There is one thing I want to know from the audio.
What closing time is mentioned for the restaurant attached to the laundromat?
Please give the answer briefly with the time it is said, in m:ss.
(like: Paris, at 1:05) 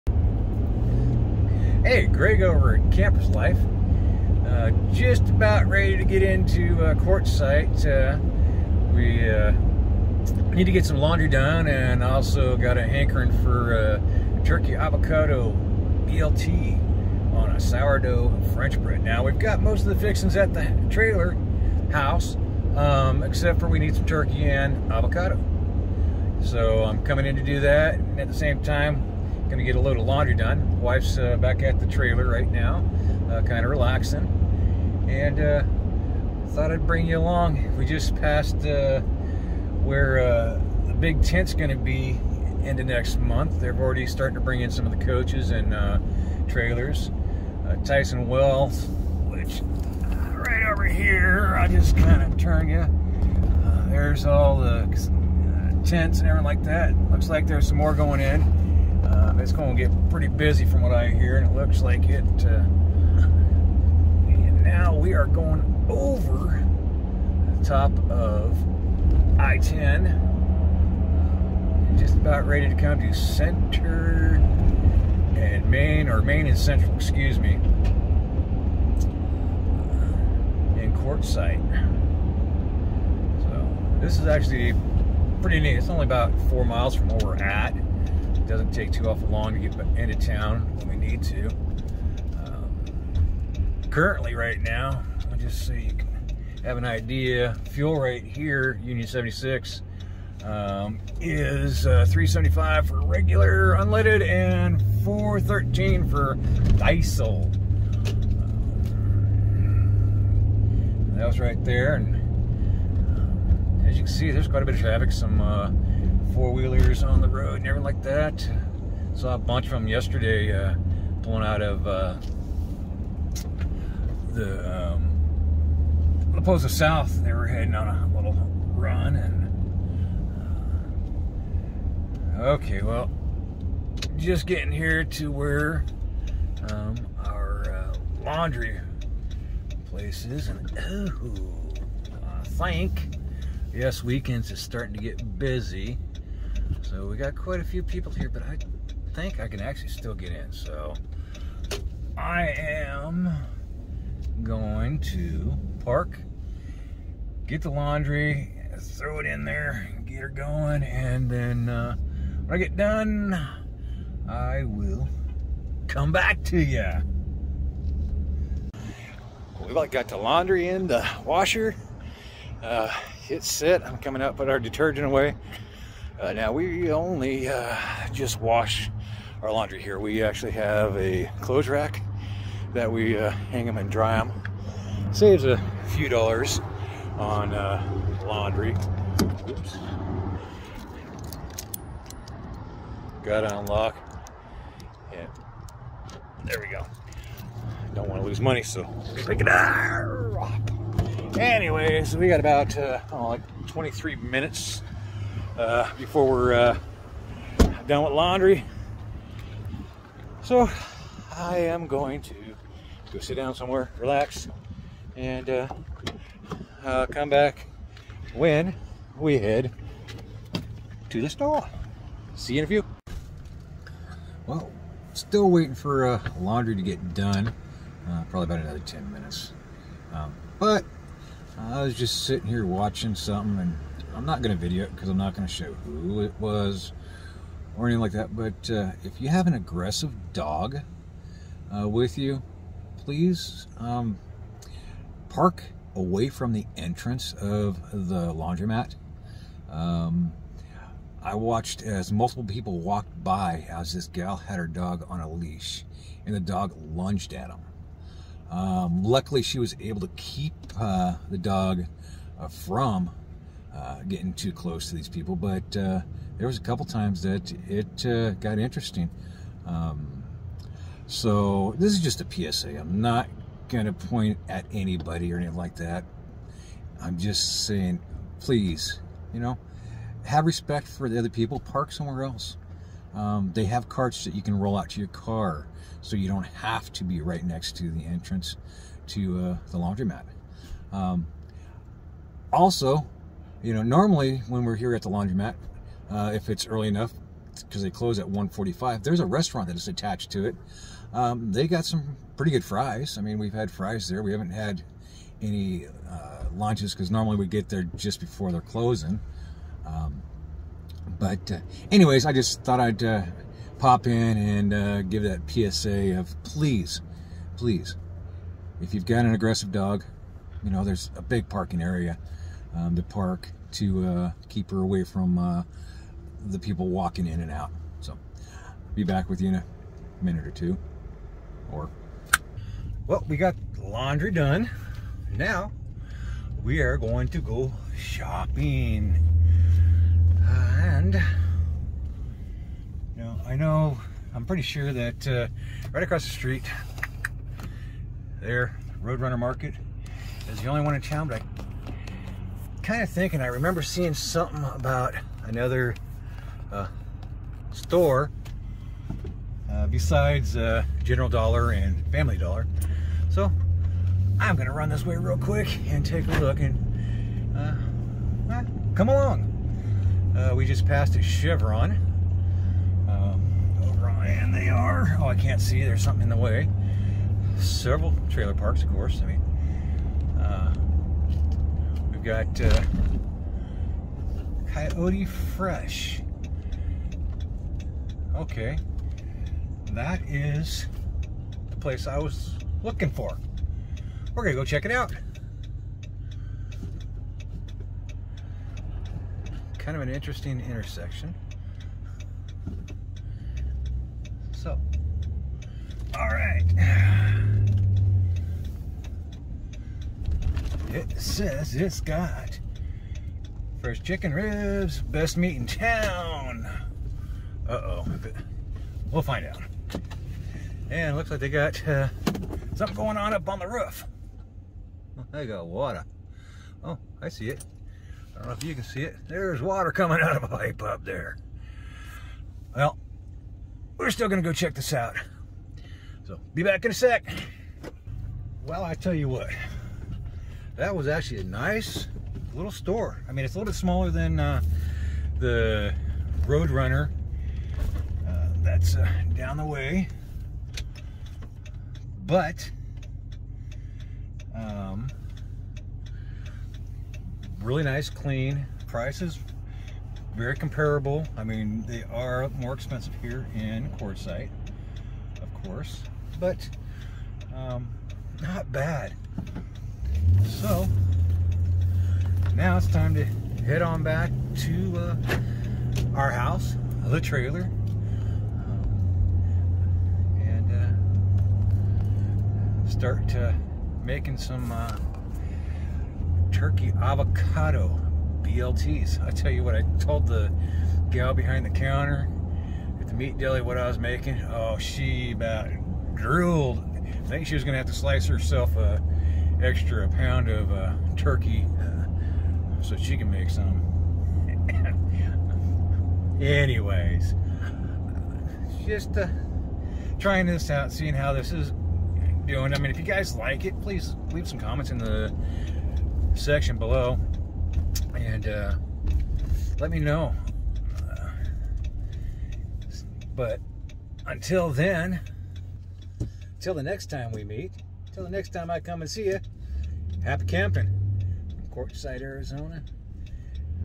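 1:45, at 4:58.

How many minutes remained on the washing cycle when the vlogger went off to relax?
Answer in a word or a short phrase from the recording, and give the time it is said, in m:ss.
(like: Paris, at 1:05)
23, at 3:23.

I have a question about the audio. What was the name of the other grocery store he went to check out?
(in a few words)
Coyote Fresh.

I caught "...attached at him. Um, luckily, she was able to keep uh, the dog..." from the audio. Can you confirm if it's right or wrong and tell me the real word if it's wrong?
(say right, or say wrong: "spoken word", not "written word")
wrong: "lunged", not "attached".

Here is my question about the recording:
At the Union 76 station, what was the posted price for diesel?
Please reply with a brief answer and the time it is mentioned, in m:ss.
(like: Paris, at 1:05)
4.13, at 1:45.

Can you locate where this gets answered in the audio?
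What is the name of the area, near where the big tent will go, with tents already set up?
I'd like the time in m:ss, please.
0:47.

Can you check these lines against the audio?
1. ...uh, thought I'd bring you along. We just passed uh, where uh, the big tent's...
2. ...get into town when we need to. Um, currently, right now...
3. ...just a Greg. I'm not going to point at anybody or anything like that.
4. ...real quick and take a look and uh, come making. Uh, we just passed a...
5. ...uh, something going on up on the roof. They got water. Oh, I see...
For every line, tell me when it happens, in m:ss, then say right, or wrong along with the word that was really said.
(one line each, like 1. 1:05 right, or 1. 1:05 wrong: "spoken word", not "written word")
1. 0:35 right
2. 1:29 right
3. 4:32 wrong: "PSA", not "Greg"
4. 6:05 wrong: "along", not "making"
5. 7:01 right.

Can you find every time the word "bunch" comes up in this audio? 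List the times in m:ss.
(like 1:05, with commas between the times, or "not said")
1:59.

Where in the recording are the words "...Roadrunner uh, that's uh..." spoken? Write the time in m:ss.
7:26.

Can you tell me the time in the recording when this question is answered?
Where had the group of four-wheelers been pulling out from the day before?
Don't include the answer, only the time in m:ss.
2:06.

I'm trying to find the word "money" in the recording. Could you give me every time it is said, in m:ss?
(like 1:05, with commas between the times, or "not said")
3:18.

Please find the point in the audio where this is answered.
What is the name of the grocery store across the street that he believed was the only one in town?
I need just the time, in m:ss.
5:49.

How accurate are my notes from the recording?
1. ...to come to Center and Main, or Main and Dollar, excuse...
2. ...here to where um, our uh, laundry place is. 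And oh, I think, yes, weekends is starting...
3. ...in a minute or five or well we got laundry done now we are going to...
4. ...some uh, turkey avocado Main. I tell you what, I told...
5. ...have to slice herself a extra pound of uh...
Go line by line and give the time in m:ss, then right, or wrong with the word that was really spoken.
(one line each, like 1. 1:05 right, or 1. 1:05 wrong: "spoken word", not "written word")
1. 1:12 wrong: "Central", not "Dollar"
2. 2:14 right
3. 5:29 wrong: "two", not "five"
4. 8:04 wrong: "BLTs", not "Main"
5. 8:17 right.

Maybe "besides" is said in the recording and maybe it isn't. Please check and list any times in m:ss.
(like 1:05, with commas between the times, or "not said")
5:59.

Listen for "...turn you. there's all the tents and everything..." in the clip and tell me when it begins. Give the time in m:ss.
0:52.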